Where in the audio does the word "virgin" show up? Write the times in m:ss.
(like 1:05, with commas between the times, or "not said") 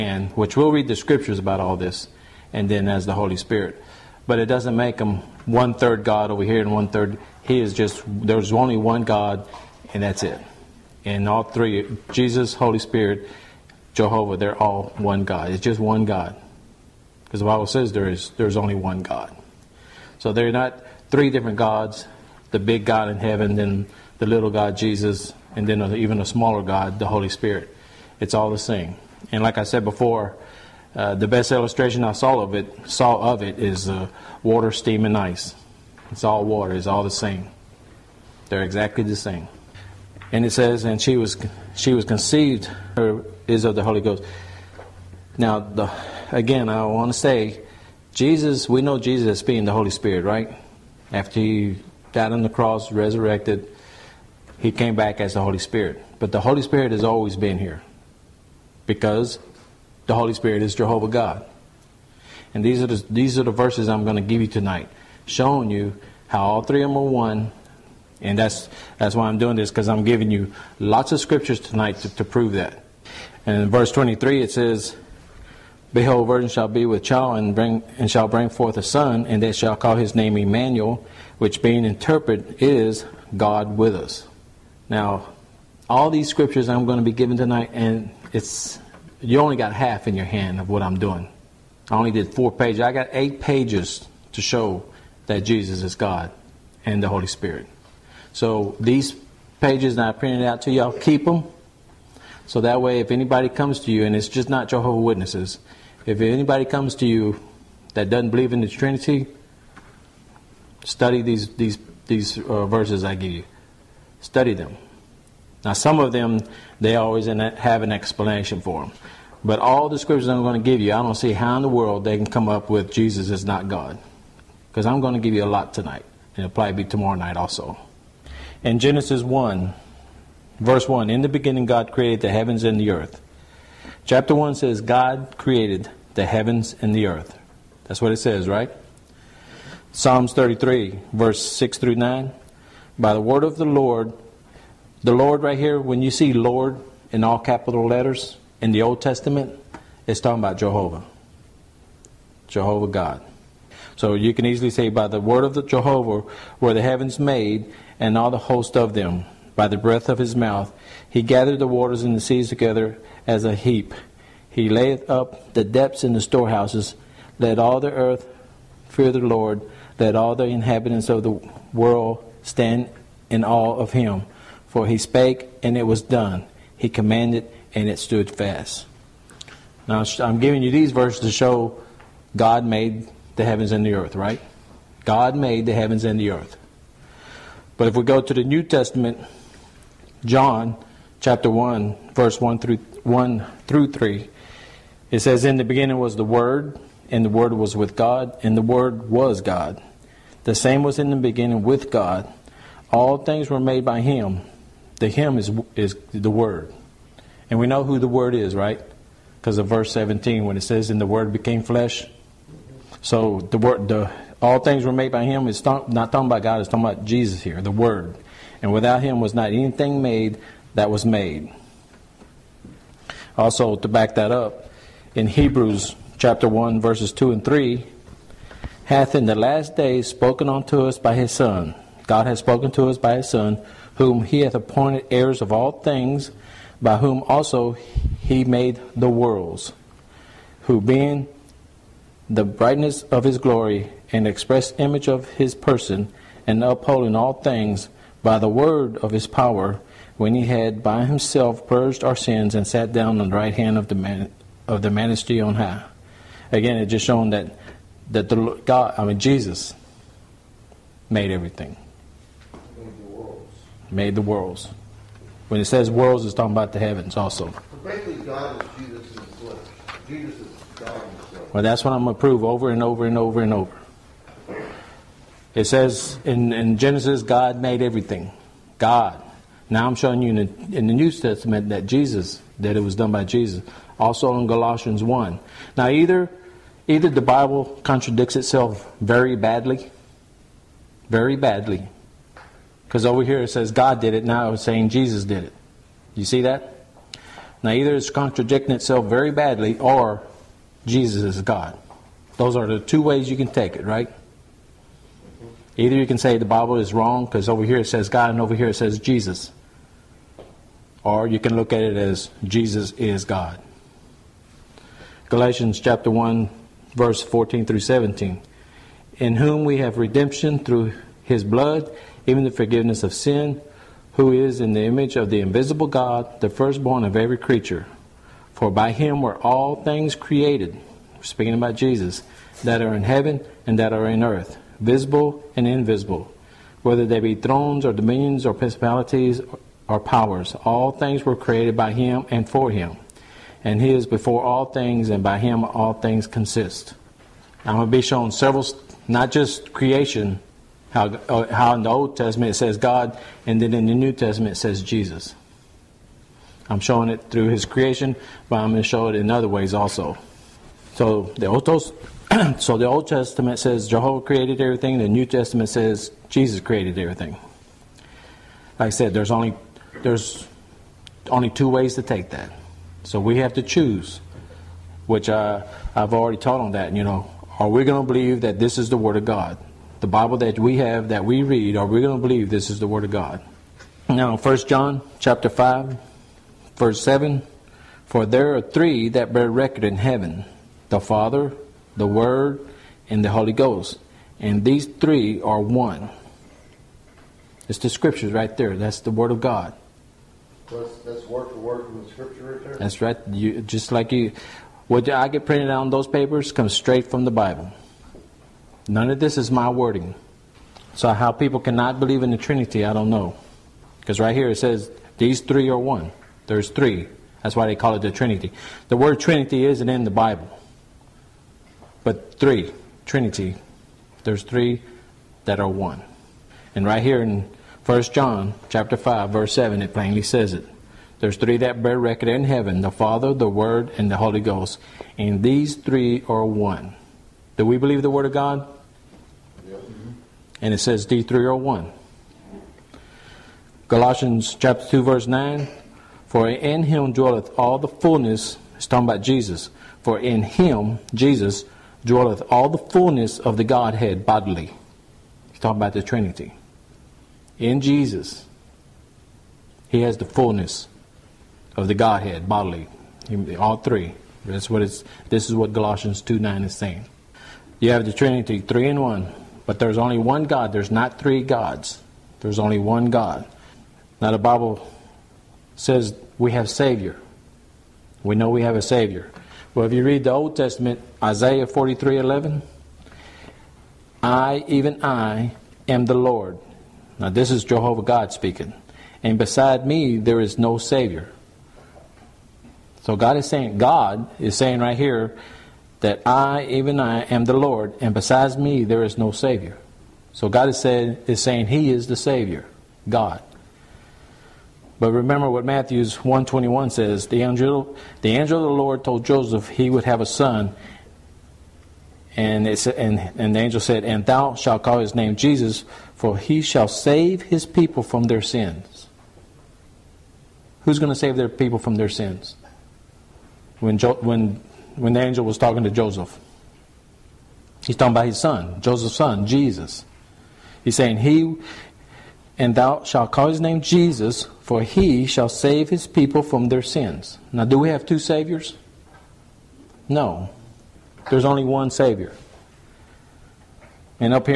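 1:16.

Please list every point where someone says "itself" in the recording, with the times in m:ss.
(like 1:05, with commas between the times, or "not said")
4:48, 4:58.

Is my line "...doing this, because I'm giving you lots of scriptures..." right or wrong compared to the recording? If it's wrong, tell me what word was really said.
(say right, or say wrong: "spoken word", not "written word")
right.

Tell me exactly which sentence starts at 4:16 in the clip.
Again, it just shown that that the God, I mean Jesus, made everything made the worlds.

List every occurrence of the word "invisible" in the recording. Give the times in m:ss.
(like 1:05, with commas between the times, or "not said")
5:25, 5:35.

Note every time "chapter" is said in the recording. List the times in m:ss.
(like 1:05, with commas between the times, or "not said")
2:14, 3:11, 3:46, 5:15, 6:25, 7:08, 7:24.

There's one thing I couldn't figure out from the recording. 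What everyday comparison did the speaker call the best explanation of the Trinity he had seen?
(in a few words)
Water, steam, and ice.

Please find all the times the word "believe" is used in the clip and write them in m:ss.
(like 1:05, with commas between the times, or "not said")
1:48, 6:18, 6:22, 6:51, 7:17.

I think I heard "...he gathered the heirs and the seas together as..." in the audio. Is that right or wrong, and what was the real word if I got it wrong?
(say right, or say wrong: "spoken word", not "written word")
wrong: "waters", not "heirs".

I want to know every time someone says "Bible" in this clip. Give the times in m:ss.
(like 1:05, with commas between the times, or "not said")
0:17, 4:47, 5:06, 6:20, 6:47, 7:00, 7:54.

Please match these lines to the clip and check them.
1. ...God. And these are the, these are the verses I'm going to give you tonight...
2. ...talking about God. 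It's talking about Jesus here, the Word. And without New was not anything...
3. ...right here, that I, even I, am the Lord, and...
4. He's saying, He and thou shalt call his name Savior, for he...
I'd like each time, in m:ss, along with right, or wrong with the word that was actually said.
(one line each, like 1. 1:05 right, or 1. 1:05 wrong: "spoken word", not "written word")
1. 1:01 right
2. 3:35 wrong: "Him", not "New"
3. 8:14 right
4. 8:50 wrong: "Jesus", not "Savior".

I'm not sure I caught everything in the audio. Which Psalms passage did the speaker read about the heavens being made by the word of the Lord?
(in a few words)
Psalms 33:6-9.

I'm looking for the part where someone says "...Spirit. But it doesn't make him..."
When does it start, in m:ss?
0:03.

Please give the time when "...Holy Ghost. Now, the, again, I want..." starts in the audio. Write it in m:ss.
0:43.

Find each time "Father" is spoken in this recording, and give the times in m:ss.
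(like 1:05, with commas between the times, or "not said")
6:30, 7:12.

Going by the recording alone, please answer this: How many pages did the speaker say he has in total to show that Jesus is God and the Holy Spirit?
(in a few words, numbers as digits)
8.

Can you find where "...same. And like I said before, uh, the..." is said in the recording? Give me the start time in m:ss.
0:28.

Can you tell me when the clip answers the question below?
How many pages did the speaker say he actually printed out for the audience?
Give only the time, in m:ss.
1:32.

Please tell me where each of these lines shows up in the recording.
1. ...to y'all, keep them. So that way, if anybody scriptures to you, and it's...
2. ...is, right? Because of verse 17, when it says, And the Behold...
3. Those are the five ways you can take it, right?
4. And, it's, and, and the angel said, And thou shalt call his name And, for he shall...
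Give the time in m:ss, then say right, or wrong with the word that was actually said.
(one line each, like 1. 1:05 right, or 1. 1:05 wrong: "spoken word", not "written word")
1. 1:40 wrong: "comes", not "scriptures"
2. 3:28 wrong: "Word", not "Behold"
3. 5:02 wrong: "two", not "five"
4. 8:32 wrong: "Jesus", not "And".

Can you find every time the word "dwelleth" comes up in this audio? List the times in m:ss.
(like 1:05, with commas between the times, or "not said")
7:27, 7:32.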